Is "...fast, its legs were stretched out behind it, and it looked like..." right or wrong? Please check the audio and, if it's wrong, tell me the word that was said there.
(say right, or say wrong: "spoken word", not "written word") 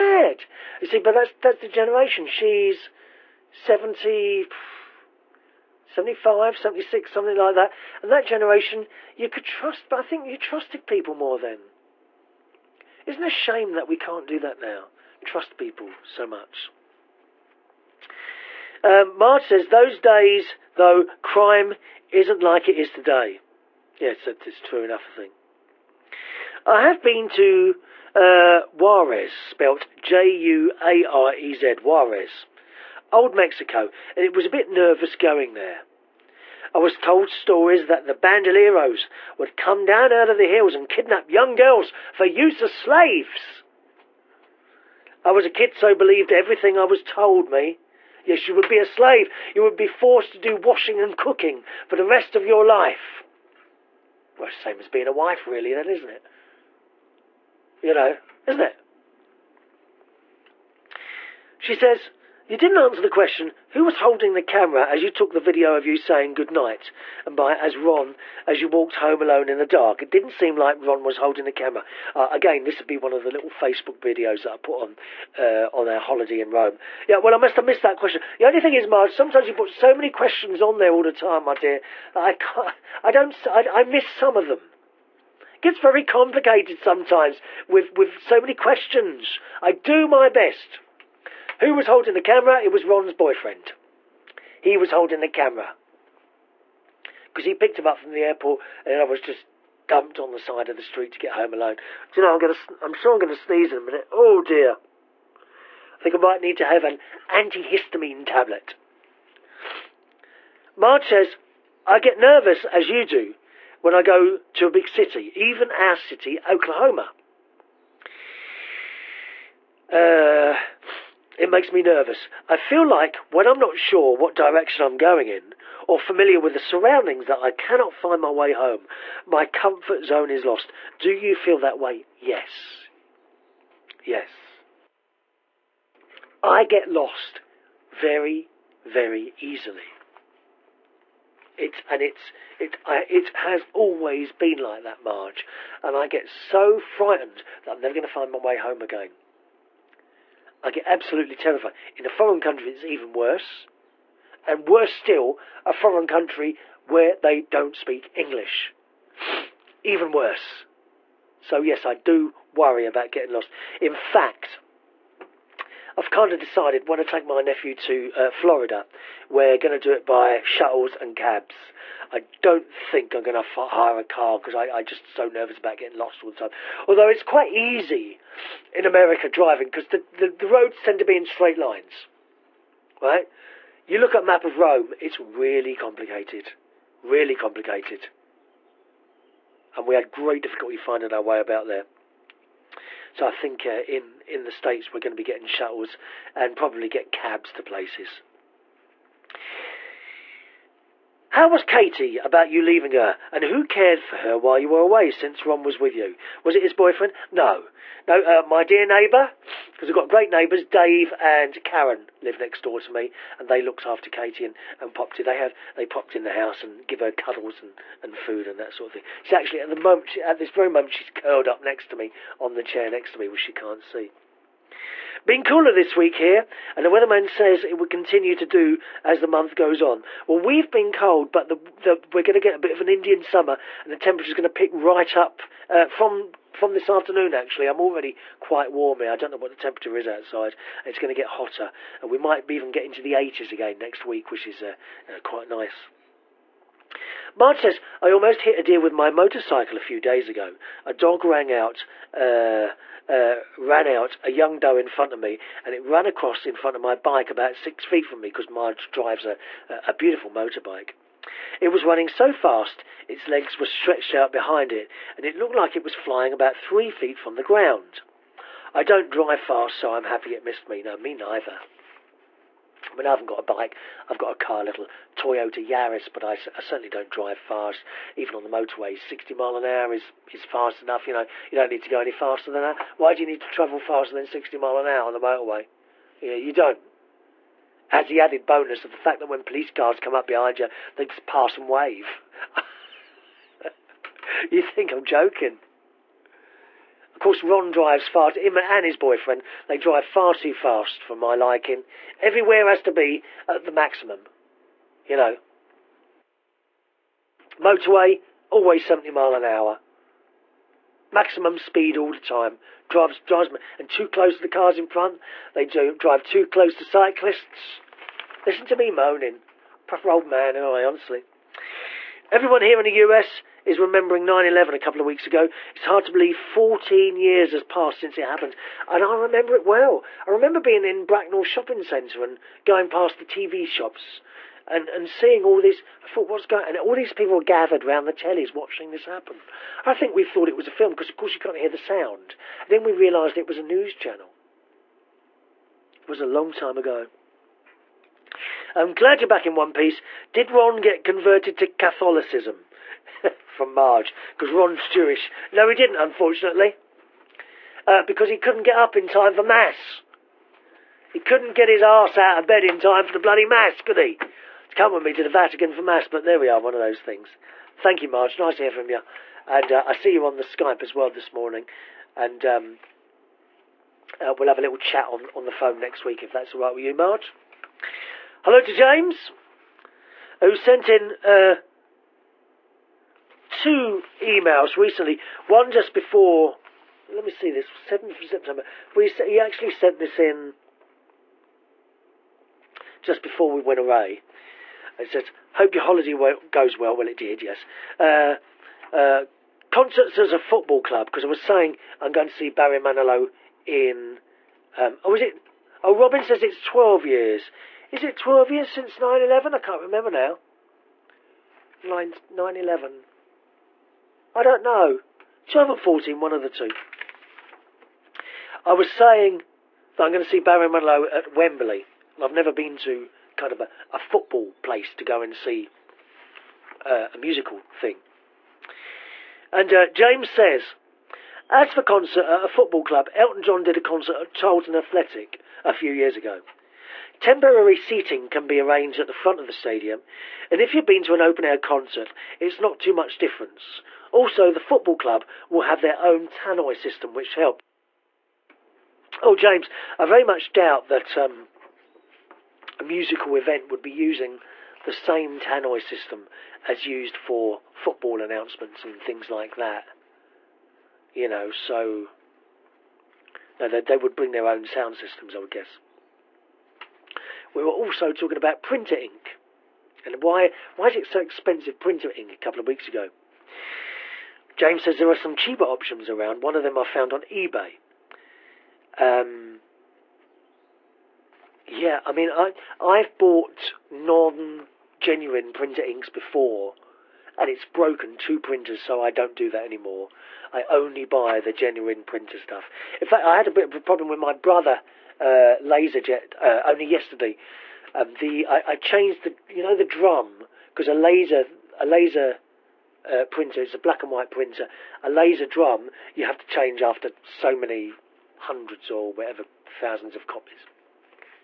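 right.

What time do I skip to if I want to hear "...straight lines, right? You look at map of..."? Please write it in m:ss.
3:01.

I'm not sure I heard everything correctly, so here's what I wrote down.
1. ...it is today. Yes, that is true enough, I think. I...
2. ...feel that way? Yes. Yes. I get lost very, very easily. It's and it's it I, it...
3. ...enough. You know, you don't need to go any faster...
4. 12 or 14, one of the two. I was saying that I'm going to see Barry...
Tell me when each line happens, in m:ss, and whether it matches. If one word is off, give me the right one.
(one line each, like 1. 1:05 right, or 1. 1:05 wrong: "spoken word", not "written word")
1. 0:22 right
2. 2:11 right
3. 4:40 right
4. 6:55 right.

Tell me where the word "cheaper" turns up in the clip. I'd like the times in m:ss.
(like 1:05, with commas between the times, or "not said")
7:55.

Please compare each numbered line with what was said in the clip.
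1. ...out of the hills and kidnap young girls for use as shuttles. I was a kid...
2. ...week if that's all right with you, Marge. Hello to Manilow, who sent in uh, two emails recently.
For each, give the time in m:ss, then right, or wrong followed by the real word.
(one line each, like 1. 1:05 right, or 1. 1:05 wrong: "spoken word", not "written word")
1. 0:40 wrong: "slaves", not "shuttles"
2. 6:16 wrong: "James", not "Manilow".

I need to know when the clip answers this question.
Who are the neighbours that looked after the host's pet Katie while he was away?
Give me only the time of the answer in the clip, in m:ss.
3:30.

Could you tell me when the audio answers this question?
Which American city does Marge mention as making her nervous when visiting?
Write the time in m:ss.
1:56.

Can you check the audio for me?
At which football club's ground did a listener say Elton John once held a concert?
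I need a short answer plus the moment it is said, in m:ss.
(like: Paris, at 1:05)
Charlton Athletic, at 7:14.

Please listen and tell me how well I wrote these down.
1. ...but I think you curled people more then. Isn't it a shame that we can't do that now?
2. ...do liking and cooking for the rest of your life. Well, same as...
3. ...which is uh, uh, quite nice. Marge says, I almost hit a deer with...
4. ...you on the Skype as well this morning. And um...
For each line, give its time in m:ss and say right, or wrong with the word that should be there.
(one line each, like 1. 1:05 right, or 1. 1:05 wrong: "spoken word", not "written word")
1. 0:09 wrong: "trusted", not "curled"
2. 0:50 wrong: "washing", not "liking"
3. 4:04 right
4. 6:10 right.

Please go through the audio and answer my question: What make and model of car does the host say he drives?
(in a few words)
Toyota Yaris.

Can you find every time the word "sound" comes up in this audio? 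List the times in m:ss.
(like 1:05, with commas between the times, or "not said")
5:41, 7:44.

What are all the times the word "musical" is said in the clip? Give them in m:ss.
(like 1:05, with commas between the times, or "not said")
7:07, 7:32.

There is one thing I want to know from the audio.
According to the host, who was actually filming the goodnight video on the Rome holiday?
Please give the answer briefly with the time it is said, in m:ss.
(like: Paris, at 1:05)
Ron's boyfriend, at 1:32.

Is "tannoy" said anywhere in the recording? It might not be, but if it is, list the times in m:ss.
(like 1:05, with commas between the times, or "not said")
7:26, 7:35.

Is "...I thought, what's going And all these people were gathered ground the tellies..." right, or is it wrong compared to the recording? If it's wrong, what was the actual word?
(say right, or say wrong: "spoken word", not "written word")
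wrong: "round", not "ground".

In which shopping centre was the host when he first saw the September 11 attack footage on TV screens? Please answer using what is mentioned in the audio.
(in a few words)
Bracknell Shopping Centre.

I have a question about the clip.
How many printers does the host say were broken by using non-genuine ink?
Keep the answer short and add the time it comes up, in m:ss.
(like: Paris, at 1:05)
2, at 8:08.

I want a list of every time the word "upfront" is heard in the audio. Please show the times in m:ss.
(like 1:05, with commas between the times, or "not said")
not said.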